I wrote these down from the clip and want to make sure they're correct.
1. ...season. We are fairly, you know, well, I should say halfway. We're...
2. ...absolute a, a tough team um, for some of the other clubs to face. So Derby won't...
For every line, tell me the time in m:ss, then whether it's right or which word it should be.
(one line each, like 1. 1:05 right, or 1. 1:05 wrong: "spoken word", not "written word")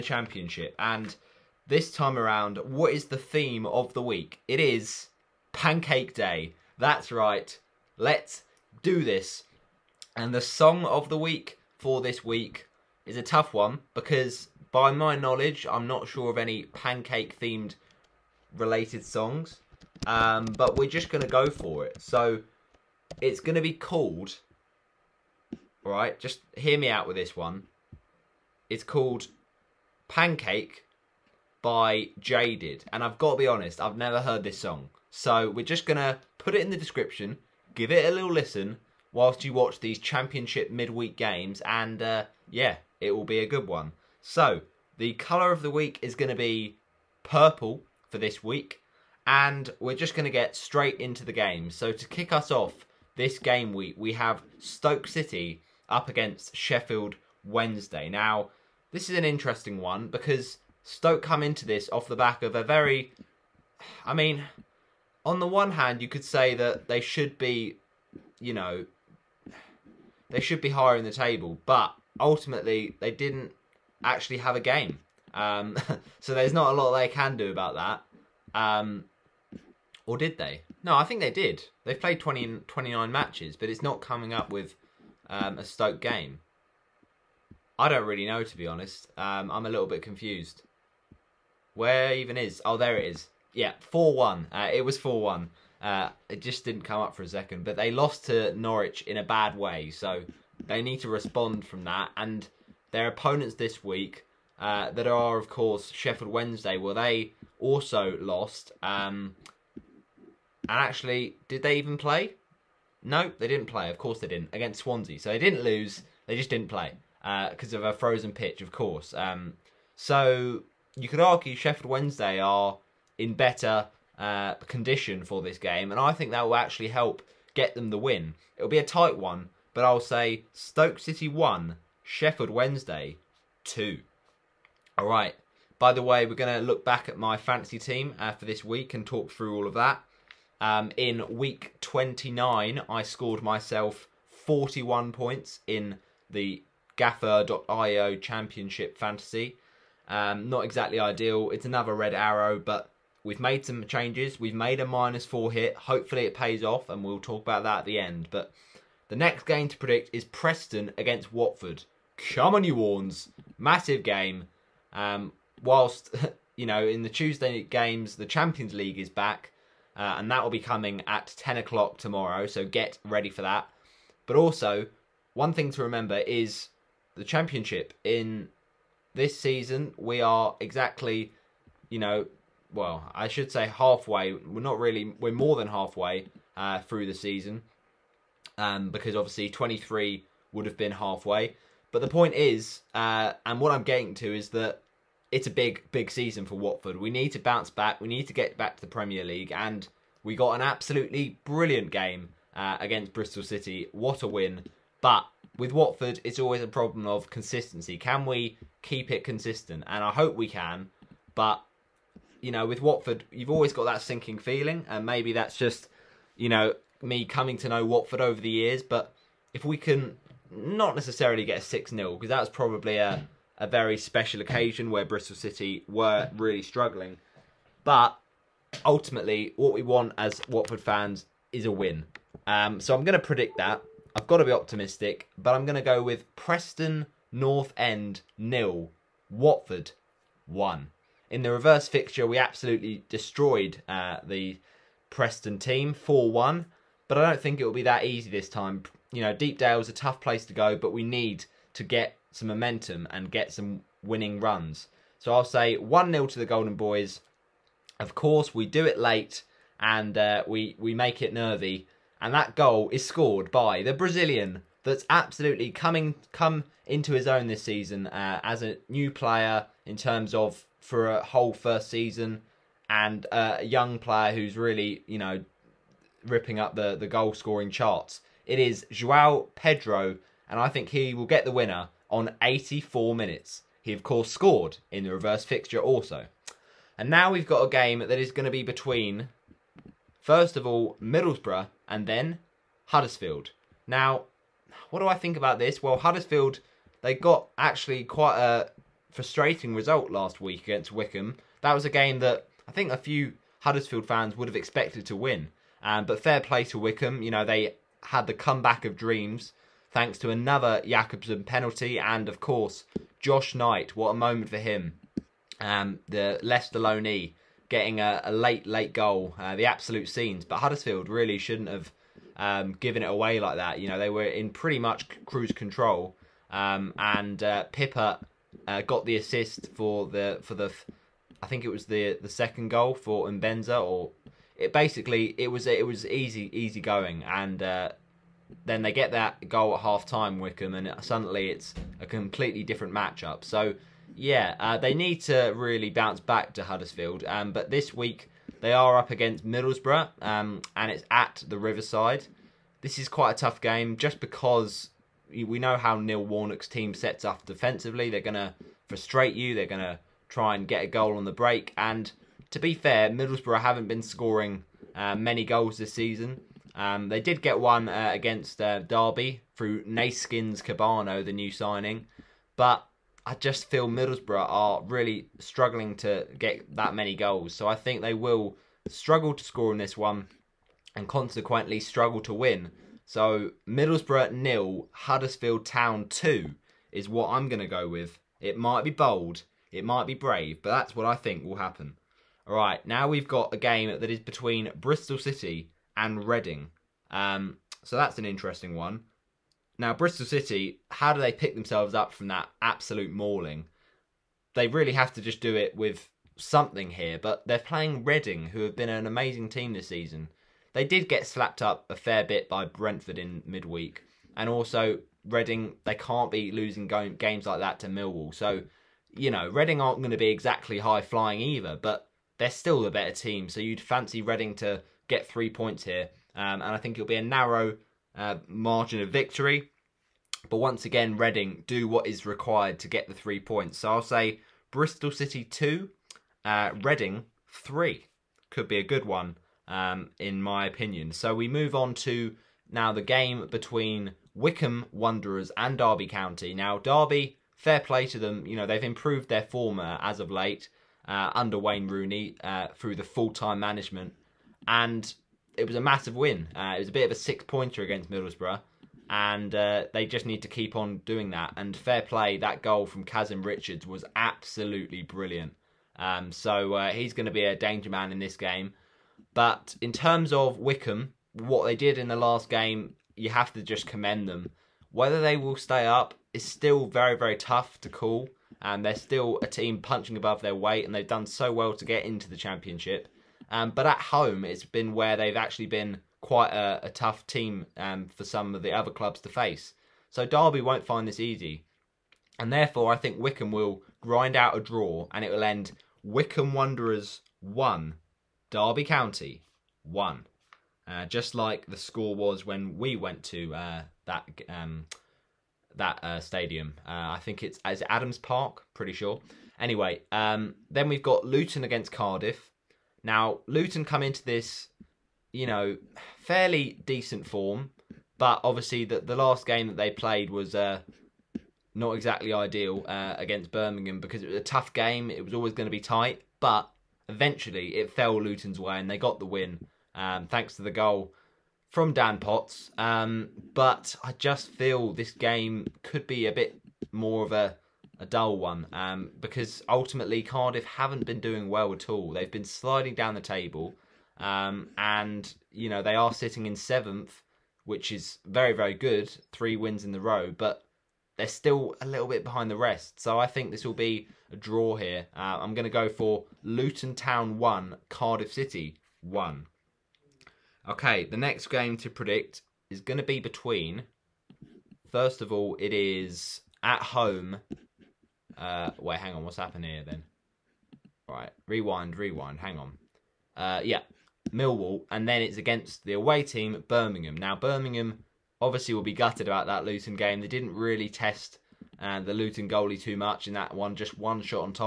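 1. 2:59 wrong: "exactly", not "fairly"
2. 8:06 wrong: "quite", not "absolute".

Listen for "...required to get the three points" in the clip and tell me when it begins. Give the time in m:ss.
7:12.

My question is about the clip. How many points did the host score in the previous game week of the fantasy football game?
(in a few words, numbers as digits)
41.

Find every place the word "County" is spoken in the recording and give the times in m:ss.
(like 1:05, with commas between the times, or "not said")
7:26, 8:18.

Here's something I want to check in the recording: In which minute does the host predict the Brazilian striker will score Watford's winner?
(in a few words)
84.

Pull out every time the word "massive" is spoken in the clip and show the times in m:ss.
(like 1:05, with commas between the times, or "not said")
2:43, 7:35.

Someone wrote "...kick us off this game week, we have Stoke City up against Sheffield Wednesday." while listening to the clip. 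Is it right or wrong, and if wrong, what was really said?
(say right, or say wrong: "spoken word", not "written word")
right.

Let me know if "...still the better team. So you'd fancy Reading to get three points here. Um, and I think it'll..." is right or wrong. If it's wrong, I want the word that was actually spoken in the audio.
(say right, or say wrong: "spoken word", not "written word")
right.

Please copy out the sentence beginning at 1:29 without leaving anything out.
Um, I'm a little bit confused.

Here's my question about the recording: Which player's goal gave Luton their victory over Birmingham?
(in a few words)
Dan Potts.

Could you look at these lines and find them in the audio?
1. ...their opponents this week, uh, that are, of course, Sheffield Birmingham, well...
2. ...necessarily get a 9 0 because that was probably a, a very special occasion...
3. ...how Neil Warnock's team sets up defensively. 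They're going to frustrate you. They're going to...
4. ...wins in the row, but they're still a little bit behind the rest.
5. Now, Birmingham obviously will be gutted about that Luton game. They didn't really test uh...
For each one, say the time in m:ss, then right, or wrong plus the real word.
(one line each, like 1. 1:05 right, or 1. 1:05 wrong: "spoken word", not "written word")
1. 1:42 wrong: "Wednesday", not "Birmingham"
2. 3:40 wrong: "6", not "9"
3. 5:55 right
4. 9:09 right
5. 9:37 right.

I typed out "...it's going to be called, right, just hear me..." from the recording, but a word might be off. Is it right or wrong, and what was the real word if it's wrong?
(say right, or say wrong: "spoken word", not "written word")
right.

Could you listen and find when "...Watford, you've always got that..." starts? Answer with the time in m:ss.
3:32.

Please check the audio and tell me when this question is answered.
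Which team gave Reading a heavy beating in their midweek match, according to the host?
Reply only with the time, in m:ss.
6:52.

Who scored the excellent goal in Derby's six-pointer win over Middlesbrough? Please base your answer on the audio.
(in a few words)
Kazim Richards.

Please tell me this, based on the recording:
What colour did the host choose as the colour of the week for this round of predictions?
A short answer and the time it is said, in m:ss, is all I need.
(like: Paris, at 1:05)
Purple, at 0:47.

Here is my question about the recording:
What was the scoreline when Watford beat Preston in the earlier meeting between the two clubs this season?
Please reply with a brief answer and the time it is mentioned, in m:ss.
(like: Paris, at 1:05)
4-1, at 4:05.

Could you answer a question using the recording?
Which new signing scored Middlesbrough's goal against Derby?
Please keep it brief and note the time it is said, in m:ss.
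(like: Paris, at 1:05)
Neeskens Kebano, at 6:09.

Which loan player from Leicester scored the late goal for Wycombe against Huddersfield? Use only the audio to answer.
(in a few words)
Josh Knight.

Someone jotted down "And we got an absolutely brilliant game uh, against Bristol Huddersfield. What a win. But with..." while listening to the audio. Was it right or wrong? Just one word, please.
wrong.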